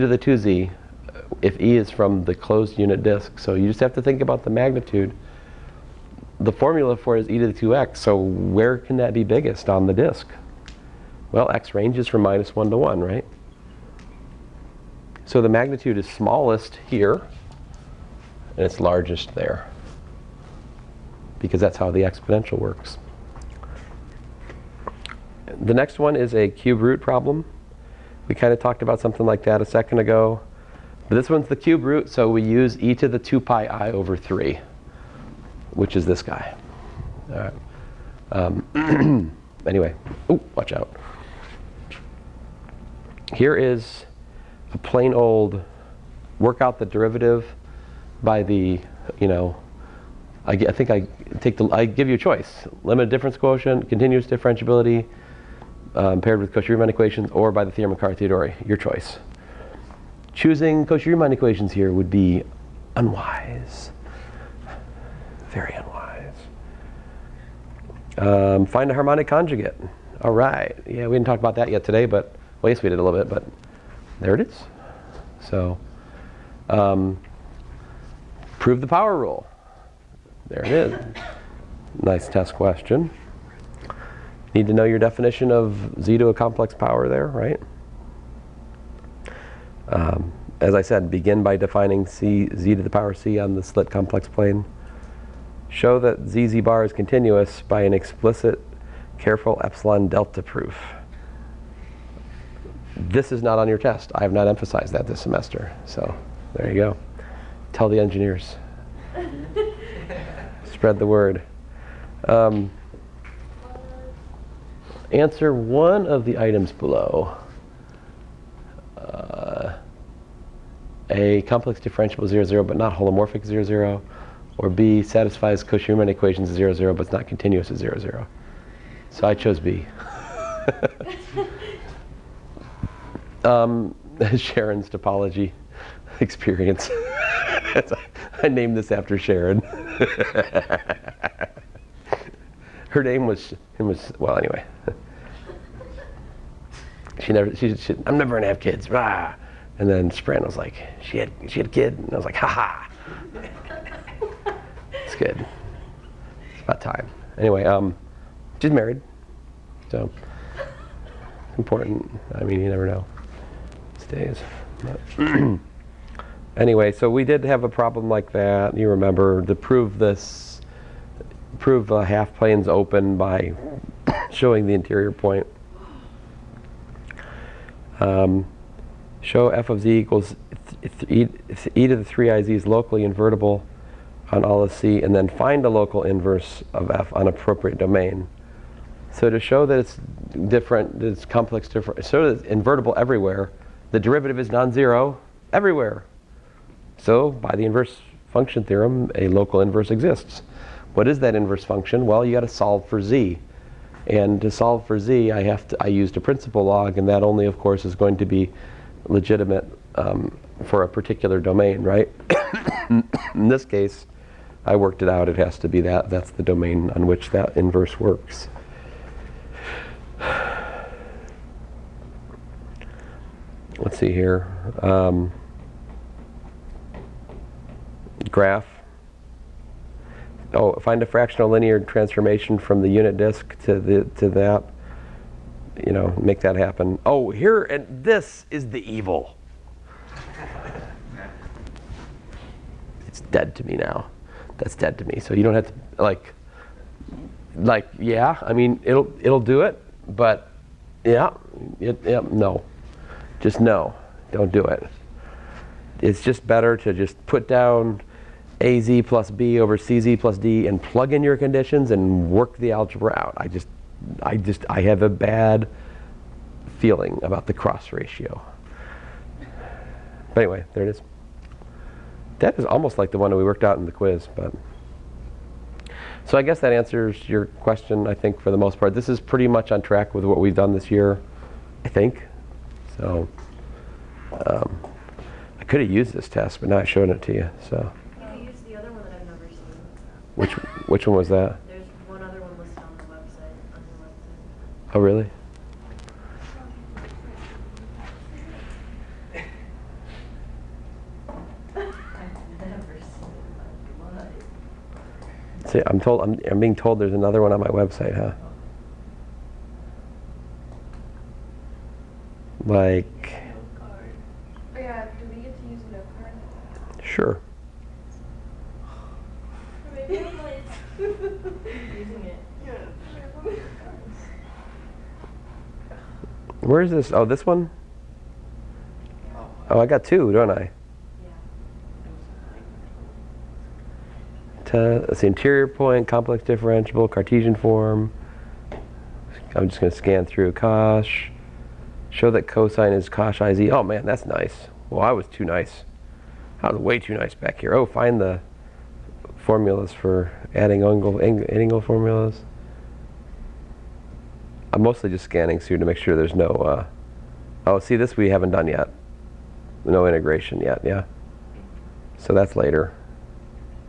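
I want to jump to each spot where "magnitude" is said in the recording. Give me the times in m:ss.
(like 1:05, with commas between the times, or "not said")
0:04, 0:15.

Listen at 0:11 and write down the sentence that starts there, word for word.
Well, x ranges from minus 1 to 1, right?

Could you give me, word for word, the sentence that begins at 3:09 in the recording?
So to show that it's different, that it's complex different, so that it's invertible everywhere, the derivative is non-zero everywhere.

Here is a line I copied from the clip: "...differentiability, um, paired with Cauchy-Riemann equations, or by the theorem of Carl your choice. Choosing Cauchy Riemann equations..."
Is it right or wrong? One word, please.
right.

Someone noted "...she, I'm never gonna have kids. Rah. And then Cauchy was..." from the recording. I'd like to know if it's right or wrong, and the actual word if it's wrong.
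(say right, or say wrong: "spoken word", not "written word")
wrong: "Sprint", not "Cauchy".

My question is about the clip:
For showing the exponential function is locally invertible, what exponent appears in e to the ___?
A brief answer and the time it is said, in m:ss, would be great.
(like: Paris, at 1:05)
3iz, at 3:02.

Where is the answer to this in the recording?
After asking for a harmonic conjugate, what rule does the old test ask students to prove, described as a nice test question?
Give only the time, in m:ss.
1:18.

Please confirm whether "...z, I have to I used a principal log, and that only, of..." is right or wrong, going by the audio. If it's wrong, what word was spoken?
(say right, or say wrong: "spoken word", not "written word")
right.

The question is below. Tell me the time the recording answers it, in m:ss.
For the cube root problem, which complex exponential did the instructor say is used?
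0:32.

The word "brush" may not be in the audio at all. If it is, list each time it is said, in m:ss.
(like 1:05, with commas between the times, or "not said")
not said.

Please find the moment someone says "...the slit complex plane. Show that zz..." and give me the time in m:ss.
1:33.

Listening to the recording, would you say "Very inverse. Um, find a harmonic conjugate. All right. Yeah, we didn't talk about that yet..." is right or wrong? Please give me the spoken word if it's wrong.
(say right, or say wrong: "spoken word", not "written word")
wrong: "unwise", not "inverse".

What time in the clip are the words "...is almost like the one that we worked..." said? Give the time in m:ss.
4:32.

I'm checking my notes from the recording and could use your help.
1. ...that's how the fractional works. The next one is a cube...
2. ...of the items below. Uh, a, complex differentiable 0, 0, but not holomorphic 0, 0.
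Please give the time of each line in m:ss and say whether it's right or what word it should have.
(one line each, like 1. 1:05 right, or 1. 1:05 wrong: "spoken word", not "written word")
1. 0:21 wrong: "exponential", not "fractional"
2. 1:56 right.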